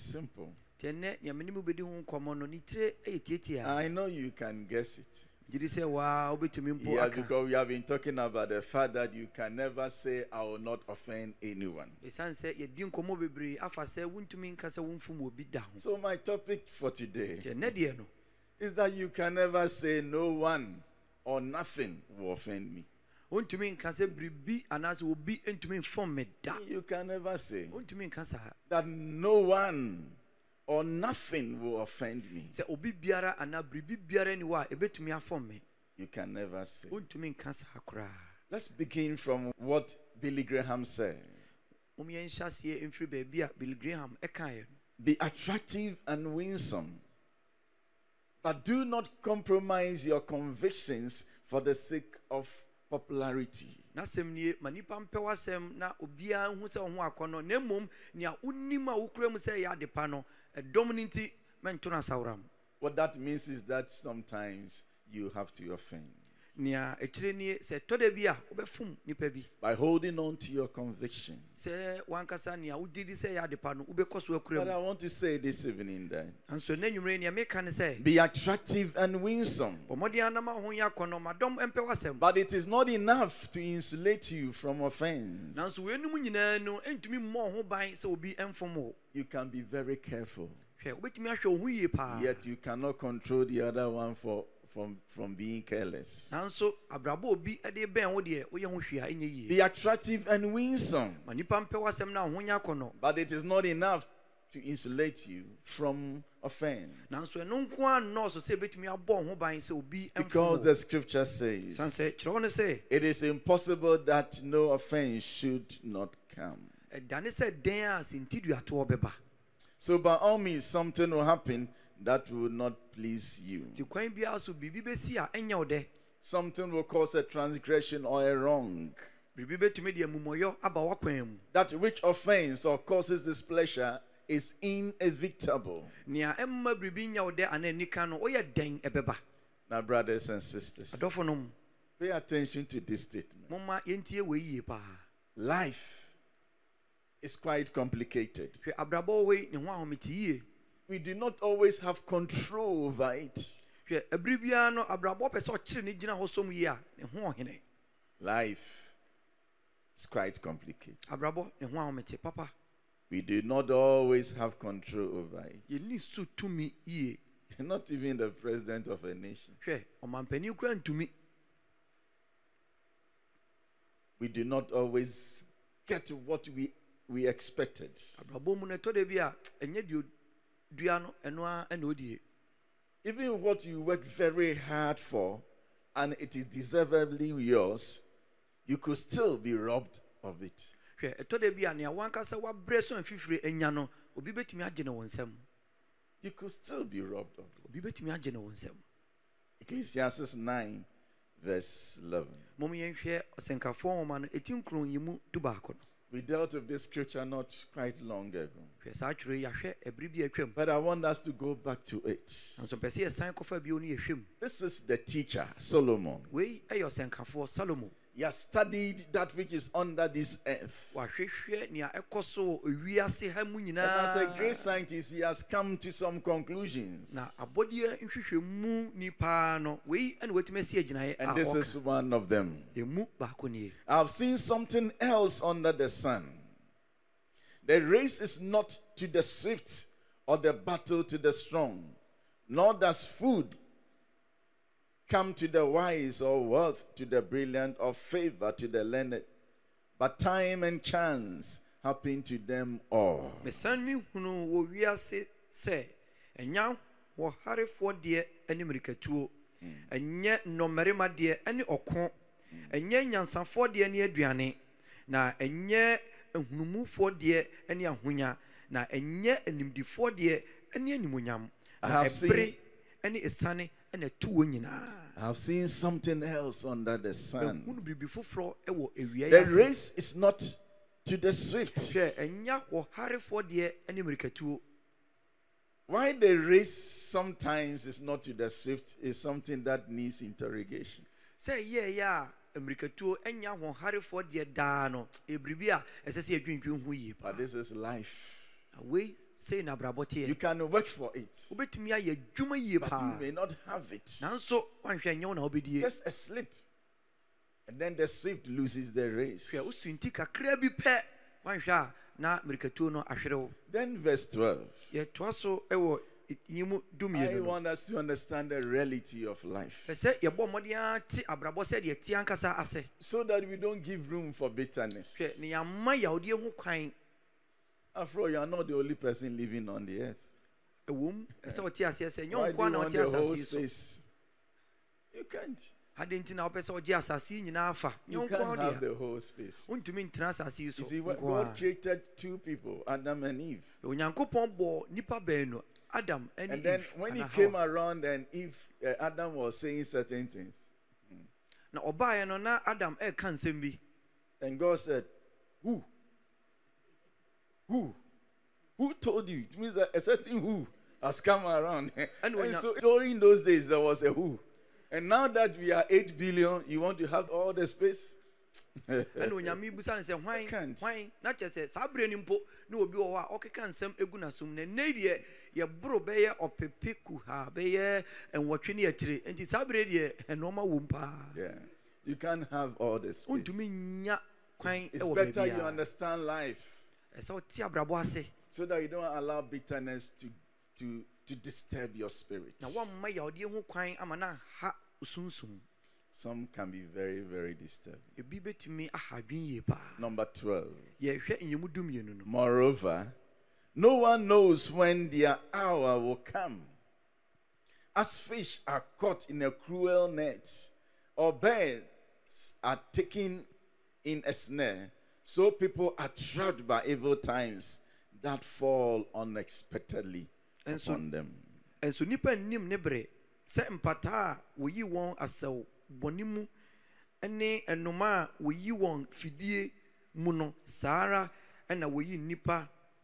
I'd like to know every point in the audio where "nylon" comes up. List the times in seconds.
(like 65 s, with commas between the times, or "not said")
not said.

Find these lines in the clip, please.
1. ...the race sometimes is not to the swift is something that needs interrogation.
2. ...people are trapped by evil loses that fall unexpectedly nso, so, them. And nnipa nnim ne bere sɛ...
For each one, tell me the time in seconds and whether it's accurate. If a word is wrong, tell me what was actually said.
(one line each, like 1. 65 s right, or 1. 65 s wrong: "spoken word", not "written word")
1. 286 s right
2. 415 s wrong: "times", not "loses".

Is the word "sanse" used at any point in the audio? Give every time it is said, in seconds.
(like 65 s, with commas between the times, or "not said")
111 s.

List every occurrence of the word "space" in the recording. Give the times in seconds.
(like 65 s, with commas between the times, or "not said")
333 s, 367 s.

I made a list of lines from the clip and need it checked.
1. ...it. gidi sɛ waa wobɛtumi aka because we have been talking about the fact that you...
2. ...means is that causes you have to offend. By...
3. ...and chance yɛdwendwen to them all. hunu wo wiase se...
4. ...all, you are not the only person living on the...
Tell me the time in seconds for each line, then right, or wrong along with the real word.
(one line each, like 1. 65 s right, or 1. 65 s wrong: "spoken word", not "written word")
1. 4 s right
2. 63 s wrong: "sometimes", not "causes"
3. 250 s wrong: "happen", not "yɛdwendwen"
4. 328 s right.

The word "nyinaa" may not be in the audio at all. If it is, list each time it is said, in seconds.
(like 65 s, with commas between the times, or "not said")
274 s, 337 s.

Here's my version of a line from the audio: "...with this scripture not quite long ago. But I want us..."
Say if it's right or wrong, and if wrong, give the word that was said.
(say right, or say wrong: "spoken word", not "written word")
right.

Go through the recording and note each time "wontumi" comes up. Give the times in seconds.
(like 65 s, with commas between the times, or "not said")
23 s, 338 s, 383 s.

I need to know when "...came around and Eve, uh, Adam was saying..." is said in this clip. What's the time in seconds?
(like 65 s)
347 s.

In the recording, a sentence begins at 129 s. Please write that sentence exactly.
That which offends or causes displeasure is inevitable.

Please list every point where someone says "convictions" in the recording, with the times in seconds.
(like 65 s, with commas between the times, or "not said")
50 s, 70 s.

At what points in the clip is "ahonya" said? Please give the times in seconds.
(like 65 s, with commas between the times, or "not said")
102 s, 267 s.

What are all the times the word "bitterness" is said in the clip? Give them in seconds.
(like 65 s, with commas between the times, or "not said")
324 s, 389 s.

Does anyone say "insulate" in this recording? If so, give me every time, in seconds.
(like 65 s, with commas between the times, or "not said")
83 s, 104 s.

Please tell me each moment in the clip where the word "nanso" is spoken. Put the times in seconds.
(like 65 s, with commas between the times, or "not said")
96 s, 107 s, 304 s.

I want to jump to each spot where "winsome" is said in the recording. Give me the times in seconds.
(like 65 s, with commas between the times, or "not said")
46 s, 79 s, 100 s.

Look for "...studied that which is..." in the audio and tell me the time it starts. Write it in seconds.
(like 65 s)
218 s.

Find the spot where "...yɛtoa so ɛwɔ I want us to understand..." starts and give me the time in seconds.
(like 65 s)
314 s.